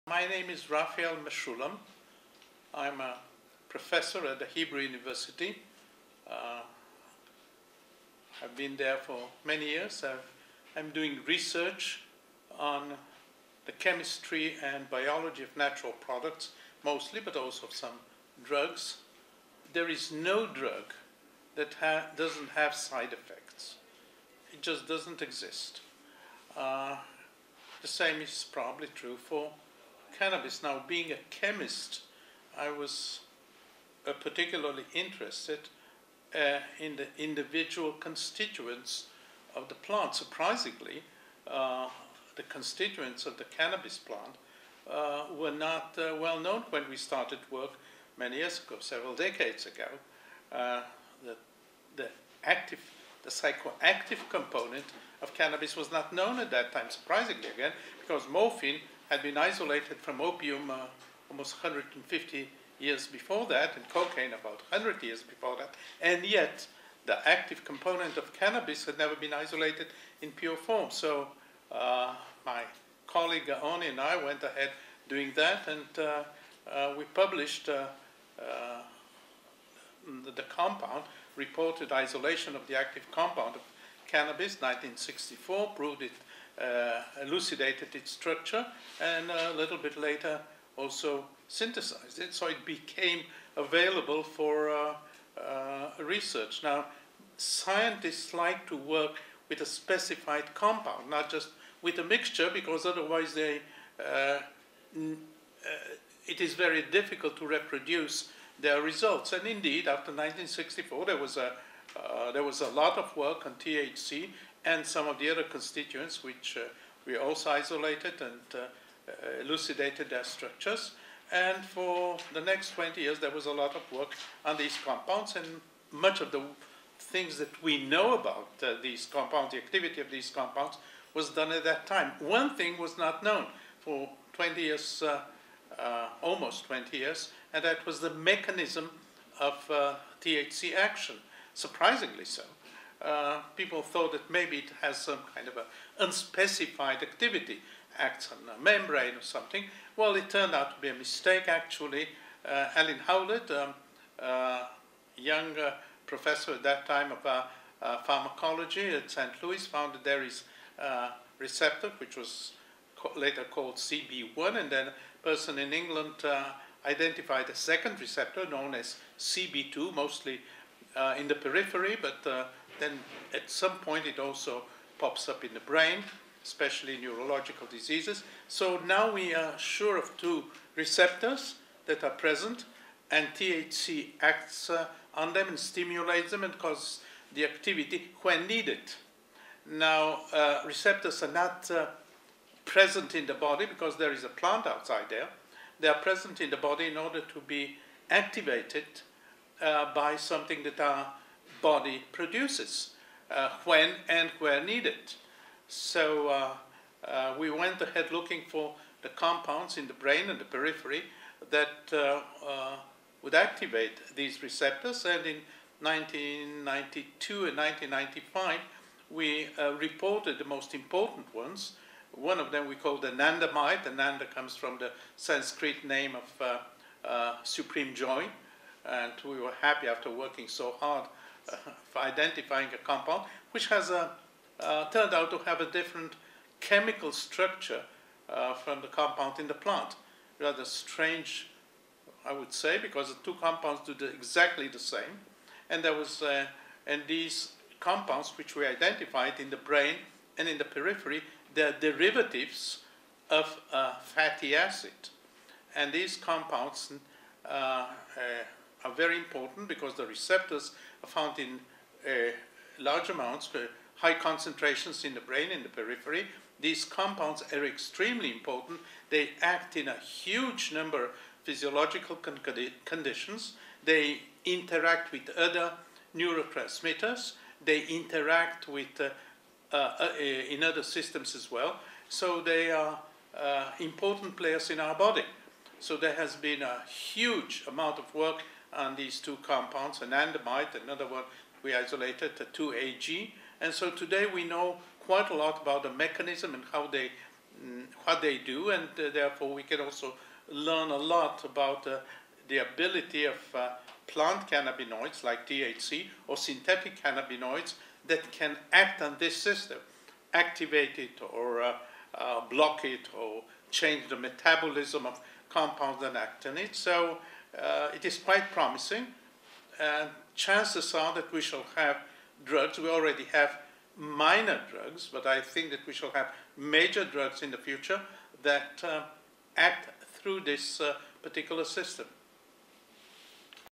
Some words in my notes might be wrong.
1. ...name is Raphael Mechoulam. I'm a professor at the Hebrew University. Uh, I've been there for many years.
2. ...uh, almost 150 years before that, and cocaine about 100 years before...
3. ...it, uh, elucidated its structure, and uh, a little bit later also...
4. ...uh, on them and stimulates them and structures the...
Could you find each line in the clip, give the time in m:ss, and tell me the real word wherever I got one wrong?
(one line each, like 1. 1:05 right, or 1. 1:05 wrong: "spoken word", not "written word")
1. 0:00 right
2. 1:00 right
3. 1:26 right
4. 3:04 wrong: "causes", not "structures".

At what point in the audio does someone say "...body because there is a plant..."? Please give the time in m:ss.
3:13.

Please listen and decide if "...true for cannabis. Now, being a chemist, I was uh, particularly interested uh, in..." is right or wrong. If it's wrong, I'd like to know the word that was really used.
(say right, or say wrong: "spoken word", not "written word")
right.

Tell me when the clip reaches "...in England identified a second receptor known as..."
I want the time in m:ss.
2:45.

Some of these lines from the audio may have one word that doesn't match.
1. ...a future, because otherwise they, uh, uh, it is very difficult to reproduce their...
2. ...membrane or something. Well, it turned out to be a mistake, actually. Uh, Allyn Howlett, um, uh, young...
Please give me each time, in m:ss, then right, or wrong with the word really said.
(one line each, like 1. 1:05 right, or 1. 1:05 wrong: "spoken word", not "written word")
1. 1:41 wrong: "mixture", not "future"
2. 2:28 right.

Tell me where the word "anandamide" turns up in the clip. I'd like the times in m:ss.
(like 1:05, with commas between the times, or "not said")
3:42, 4:49.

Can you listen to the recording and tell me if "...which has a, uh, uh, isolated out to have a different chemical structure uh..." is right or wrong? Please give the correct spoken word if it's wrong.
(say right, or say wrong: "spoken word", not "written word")
wrong: "turned", not "isolated".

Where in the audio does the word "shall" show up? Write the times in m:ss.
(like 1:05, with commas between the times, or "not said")
5:21, 5:25.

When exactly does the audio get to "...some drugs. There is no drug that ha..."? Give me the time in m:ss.
0:17.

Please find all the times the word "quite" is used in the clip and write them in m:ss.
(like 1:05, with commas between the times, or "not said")
4:55, 5:18.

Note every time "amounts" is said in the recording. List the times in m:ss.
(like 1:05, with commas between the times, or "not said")
4:23, 4:47.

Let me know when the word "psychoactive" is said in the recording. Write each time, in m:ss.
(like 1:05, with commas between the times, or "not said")
0:53.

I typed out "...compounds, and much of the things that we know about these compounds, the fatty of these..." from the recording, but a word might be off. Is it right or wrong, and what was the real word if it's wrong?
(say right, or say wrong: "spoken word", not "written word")
wrong: "activity", not "fatty".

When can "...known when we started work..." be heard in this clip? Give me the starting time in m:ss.
0:46.